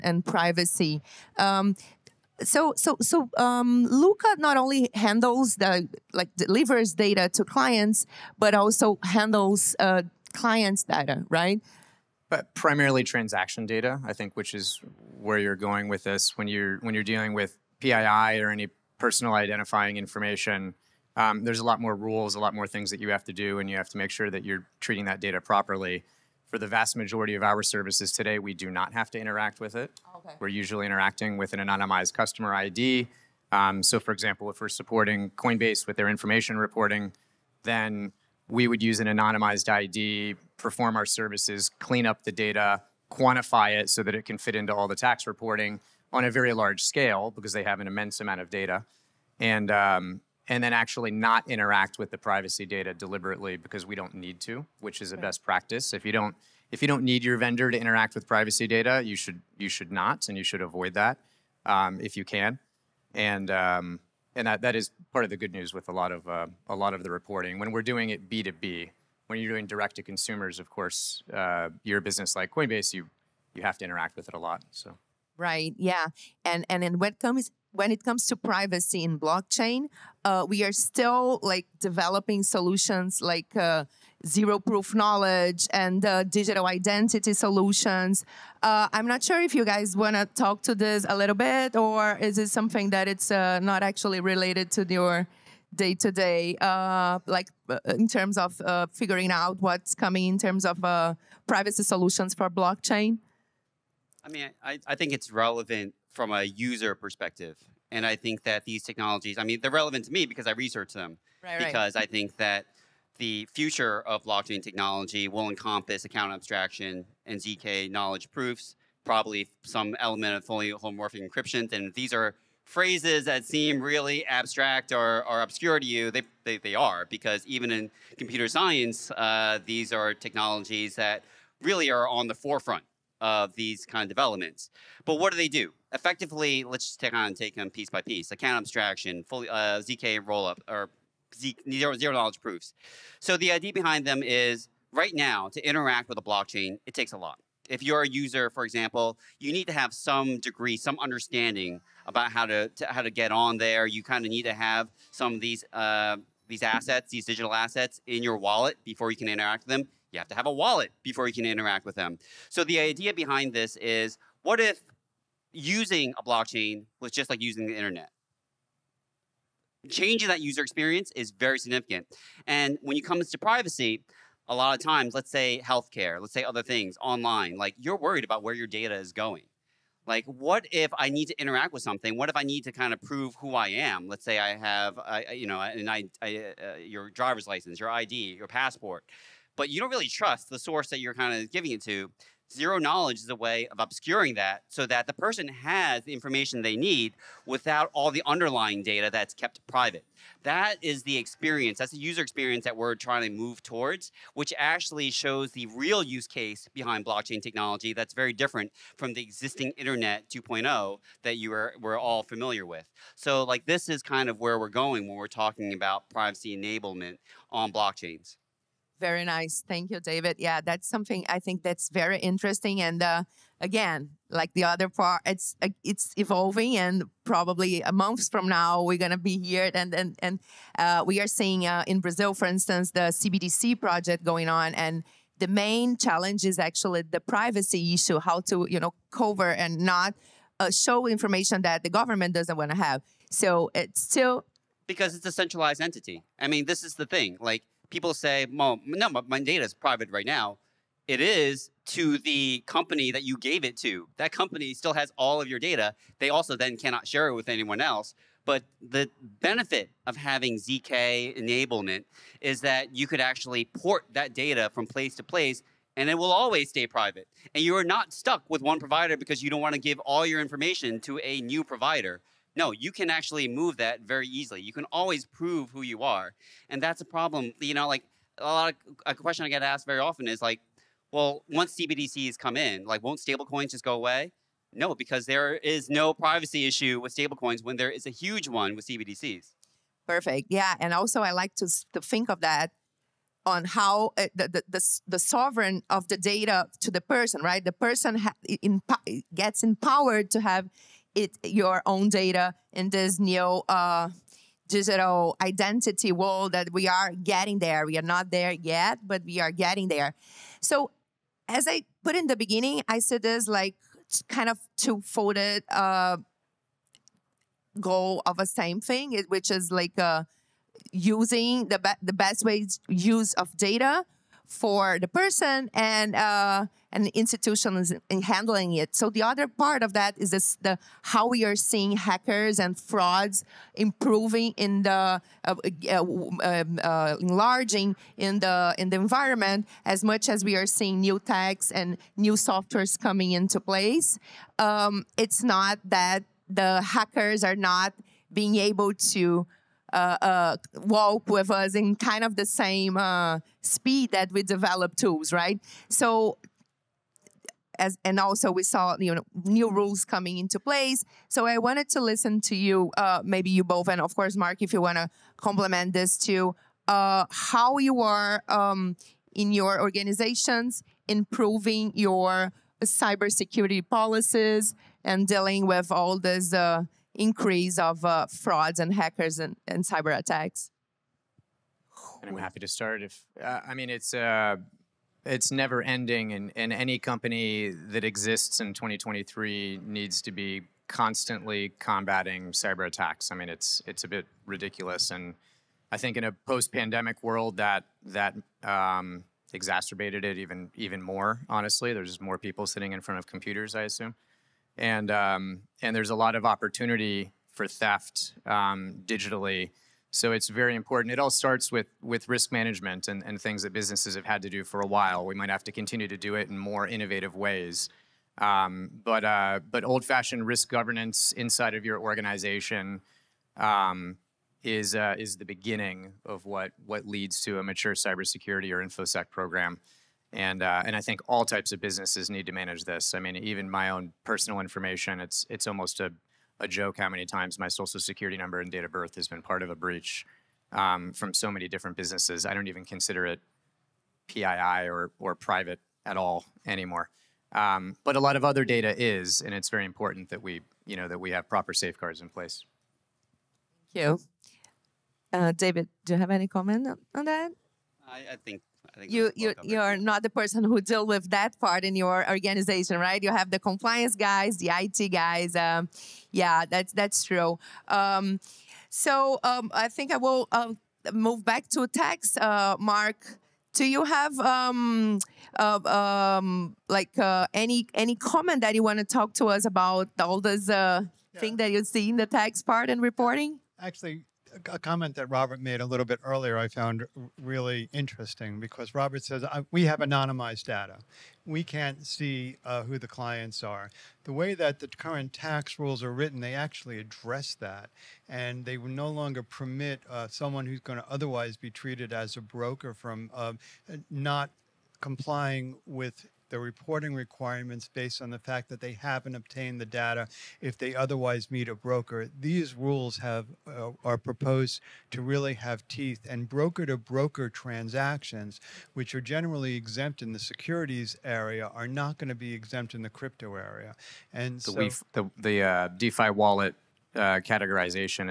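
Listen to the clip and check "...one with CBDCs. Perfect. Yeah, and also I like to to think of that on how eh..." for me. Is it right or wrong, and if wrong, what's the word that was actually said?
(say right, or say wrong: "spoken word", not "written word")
right.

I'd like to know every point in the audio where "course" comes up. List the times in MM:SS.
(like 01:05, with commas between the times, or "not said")
01:10, 06:04.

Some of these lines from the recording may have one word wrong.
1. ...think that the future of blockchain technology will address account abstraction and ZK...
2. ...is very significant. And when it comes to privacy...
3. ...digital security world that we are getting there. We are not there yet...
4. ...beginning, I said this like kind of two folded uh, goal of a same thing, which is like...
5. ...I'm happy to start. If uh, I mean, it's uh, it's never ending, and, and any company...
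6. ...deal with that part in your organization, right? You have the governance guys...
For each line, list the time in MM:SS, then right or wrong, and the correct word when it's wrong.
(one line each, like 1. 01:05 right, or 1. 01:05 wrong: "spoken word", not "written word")
1. 01:52 wrong: "encompass", not "address"
2. 02:51 right
3. 05:04 wrong: "identity", not "security"
4. 05:12 right
5. 06:22 right
6. 07:40 wrong: "compliance", not "governance".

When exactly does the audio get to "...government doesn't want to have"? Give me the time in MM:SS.
04:01.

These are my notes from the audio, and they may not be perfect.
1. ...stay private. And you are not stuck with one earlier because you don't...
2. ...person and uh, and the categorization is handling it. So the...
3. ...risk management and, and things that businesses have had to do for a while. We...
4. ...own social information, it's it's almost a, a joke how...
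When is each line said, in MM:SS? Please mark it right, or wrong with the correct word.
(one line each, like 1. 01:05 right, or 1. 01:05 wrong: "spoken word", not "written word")
1. 04:26 wrong: "provider", not "earlier"
2. 05:25 wrong: "institution", not "categorization"
3. 06:52 right
4. 07:13 wrong: "personal", not "social".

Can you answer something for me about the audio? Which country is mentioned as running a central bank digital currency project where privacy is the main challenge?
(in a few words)
Brazil.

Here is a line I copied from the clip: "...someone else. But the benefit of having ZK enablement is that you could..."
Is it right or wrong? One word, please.
wrong.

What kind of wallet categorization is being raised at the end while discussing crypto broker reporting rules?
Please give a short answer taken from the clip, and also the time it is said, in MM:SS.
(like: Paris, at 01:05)
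DeFi wallet, at 08:45.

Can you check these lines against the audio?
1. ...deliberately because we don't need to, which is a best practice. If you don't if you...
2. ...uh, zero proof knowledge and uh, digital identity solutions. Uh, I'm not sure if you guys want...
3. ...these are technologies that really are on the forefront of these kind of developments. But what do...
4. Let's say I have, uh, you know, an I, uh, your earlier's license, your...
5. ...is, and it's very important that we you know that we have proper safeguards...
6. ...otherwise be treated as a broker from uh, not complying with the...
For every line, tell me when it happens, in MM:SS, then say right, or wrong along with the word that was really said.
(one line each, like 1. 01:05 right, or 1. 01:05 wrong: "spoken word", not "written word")
1. 00:52 right
2. 01:23 right
3. 02:09 right
4. 03:04 wrong: "driver", not "earlier"
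5. 07:28 right
6. 08:21 right.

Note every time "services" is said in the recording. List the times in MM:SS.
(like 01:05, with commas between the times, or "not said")
00:27, 00:41.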